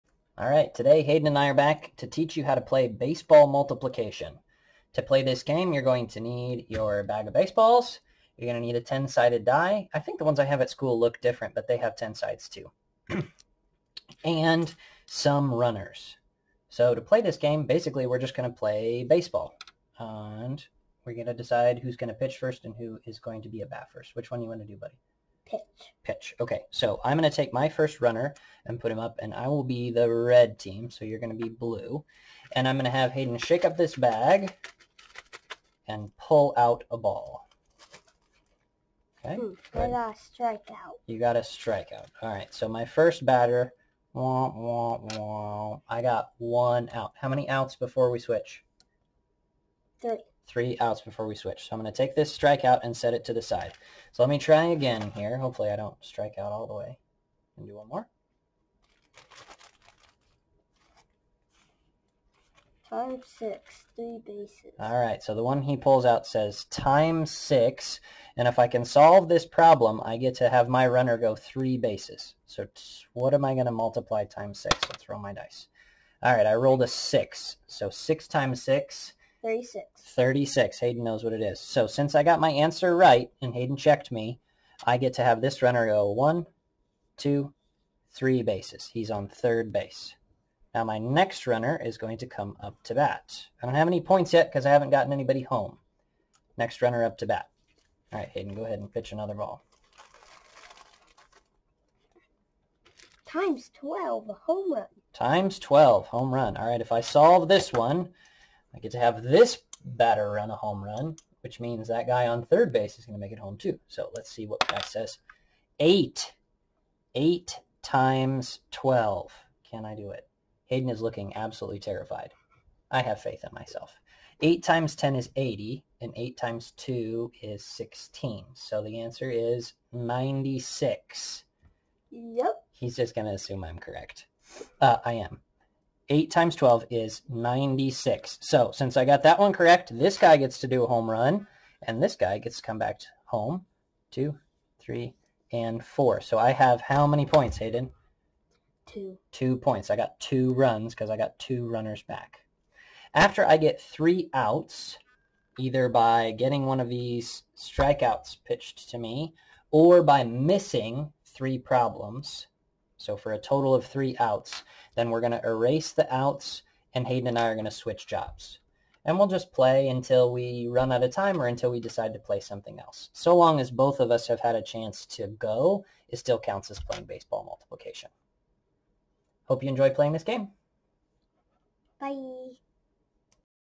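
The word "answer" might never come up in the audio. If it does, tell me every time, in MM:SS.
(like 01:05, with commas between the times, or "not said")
01:22, 02:08.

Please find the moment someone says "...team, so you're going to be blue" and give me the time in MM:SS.
00:30.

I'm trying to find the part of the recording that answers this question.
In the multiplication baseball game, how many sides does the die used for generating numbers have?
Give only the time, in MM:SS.
00:08.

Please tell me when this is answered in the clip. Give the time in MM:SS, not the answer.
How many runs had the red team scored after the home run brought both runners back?
02:29.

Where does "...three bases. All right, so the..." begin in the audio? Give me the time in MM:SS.
01:03.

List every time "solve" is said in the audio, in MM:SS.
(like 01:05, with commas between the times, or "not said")
01:08, 01:47.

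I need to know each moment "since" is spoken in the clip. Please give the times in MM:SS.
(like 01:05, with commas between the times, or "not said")
01:21, 02:18.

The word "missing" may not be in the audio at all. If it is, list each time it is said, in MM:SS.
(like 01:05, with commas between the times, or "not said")
02:40.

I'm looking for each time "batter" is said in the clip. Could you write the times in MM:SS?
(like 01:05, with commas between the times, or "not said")
00:43, 01:49.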